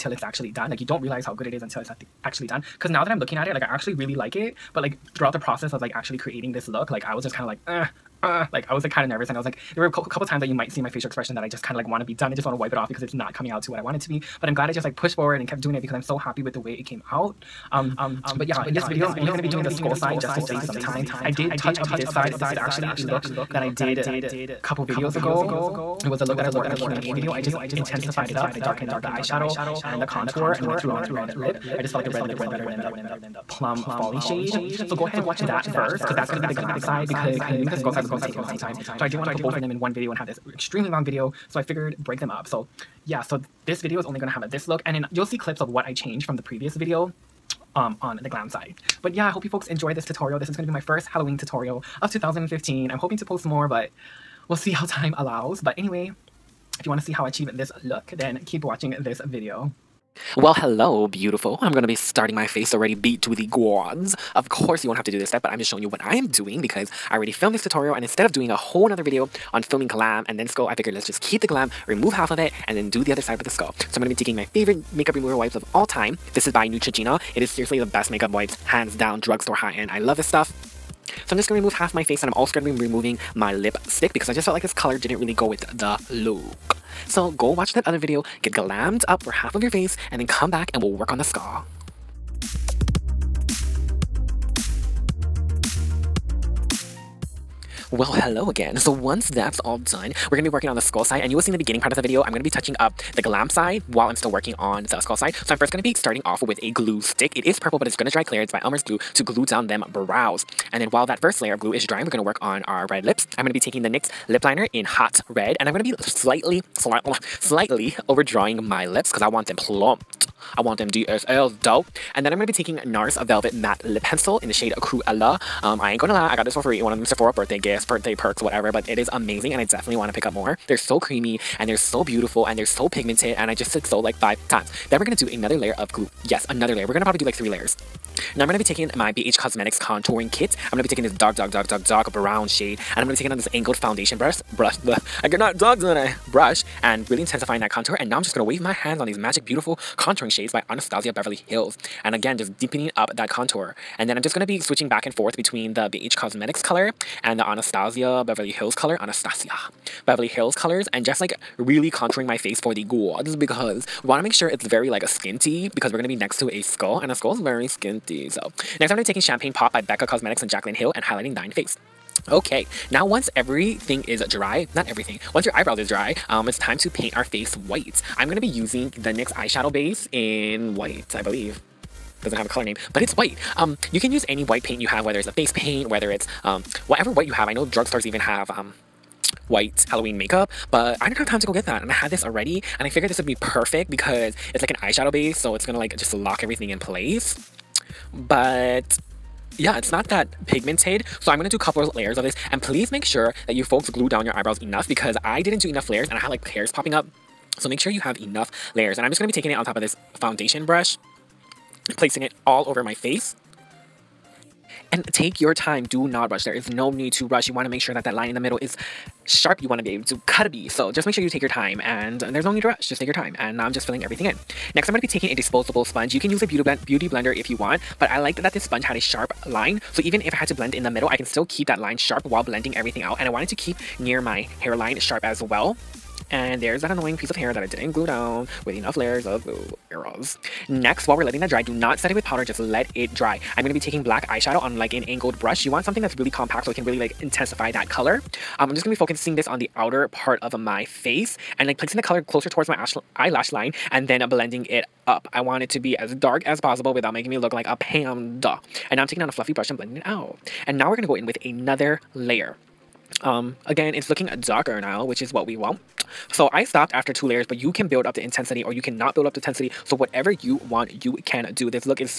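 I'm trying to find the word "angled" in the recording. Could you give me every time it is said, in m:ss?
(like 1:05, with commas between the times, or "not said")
2:23, 4:05.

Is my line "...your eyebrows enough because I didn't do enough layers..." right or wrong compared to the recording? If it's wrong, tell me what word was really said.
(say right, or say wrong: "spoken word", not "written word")
right.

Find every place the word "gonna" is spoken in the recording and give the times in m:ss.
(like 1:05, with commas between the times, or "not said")
1:01, 1:13, 3:15.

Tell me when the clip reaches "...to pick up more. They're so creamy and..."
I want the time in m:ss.
2:10.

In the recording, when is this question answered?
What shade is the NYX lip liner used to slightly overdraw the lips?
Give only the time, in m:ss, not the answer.
1:54.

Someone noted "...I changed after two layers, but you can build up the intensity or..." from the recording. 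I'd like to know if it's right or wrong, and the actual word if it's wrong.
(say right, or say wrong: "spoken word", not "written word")
wrong: "stopped", not "changed".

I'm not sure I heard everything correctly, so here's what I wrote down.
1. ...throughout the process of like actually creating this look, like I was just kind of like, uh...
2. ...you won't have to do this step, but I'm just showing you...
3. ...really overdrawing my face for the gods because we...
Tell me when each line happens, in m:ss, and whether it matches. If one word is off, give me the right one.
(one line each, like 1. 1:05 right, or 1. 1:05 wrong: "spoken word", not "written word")
1. 0:05 right
2. 1:04 right
3. 2:41 wrong: "contouring", not "overdrawing".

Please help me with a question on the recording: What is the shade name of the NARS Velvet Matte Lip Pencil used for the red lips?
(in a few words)
Cruella.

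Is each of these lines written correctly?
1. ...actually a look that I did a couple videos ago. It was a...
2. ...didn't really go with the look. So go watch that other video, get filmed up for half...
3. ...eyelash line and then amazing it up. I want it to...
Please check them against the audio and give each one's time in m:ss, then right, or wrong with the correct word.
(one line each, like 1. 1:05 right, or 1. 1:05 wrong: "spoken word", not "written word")
1. 0:22 right
2. 1:24 wrong: "glammed", not "filmed"
3. 4:13 wrong: "blending", not "amazing".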